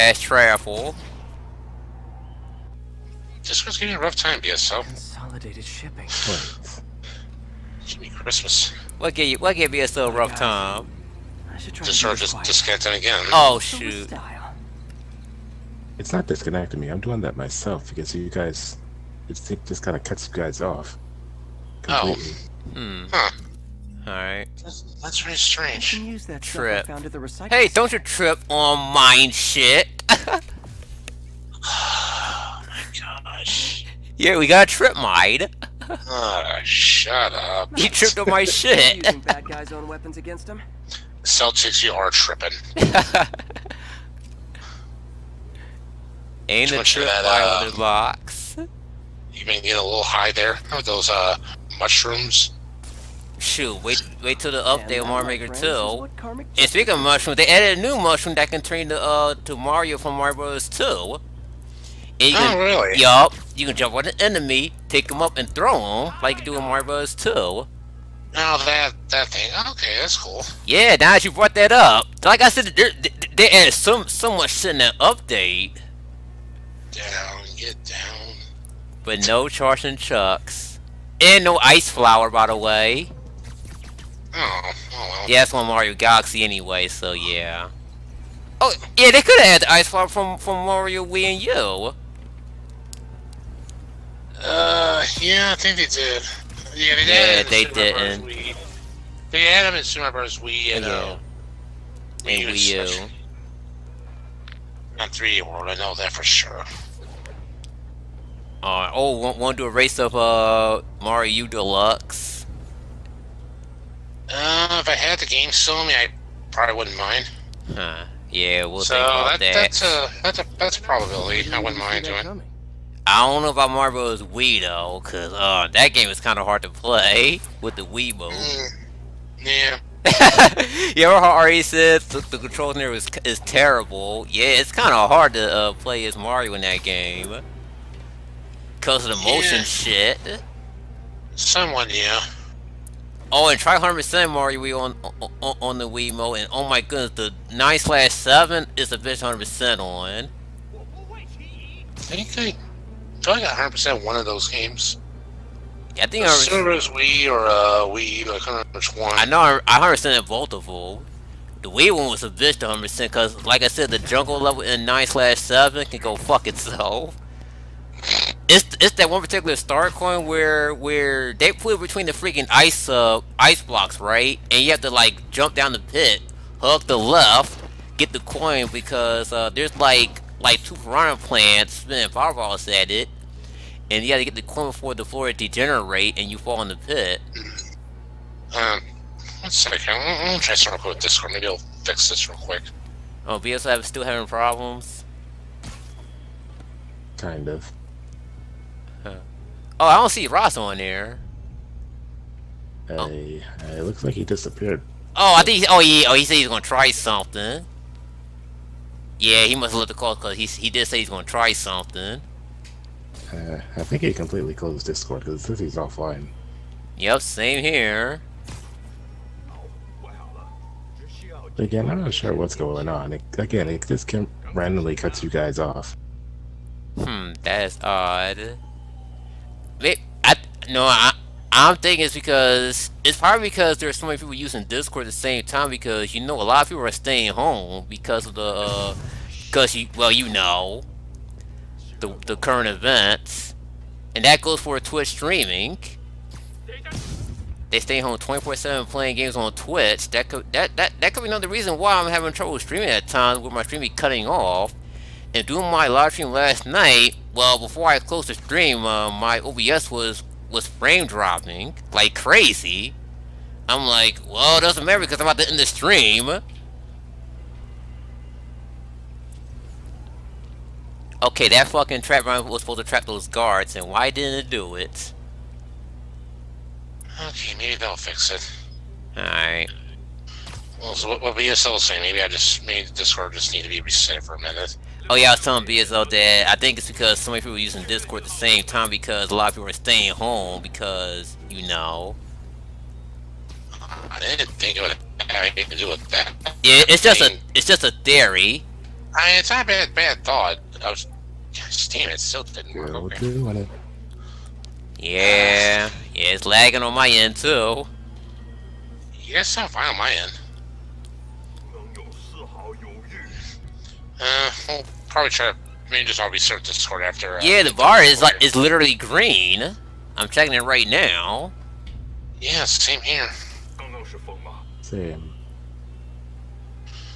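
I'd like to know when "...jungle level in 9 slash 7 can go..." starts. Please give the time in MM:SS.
02:43.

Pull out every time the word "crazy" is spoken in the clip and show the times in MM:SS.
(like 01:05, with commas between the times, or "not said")
04:22.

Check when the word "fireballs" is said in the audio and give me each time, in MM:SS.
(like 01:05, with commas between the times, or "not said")
03:02.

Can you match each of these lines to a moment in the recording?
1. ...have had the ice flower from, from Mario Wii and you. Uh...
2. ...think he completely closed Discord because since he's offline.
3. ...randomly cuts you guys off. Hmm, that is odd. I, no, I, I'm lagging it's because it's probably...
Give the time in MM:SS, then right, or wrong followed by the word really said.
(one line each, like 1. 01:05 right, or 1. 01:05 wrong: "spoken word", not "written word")
1. 01:29 right
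2. 03:33 right
3. 03:44 wrong: "thinking", not "lagging".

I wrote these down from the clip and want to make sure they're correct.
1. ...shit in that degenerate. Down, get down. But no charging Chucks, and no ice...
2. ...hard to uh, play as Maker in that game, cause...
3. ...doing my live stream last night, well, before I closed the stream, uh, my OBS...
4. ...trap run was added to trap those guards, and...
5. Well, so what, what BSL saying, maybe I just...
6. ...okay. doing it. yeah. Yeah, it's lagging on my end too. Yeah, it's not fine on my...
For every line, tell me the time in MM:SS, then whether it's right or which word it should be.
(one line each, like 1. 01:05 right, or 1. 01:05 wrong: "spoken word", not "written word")
1. 01:14 wrong: "update", not "degenerate"
2. 02:15 wrong: "Mario", not "Maker"
3. 04:15 right
4. 04:32 wrong: "supposed", not "added"
5. 04:40 right
6. 05:02 right.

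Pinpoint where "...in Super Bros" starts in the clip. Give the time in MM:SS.
01:39.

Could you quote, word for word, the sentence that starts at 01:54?
Uh, if I had the game still on me, I probably wouldn't mind.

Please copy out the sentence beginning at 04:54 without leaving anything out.
I didn't think it would have anything to do with that.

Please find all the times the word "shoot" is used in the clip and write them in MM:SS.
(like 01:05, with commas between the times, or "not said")
00:13, 00:53.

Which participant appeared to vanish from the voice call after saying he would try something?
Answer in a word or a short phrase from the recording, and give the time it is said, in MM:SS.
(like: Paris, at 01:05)
Ross, at 03:20.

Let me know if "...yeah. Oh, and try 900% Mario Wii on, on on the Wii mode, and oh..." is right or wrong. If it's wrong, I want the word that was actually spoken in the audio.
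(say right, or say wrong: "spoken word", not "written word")
wrong: "100", not "900".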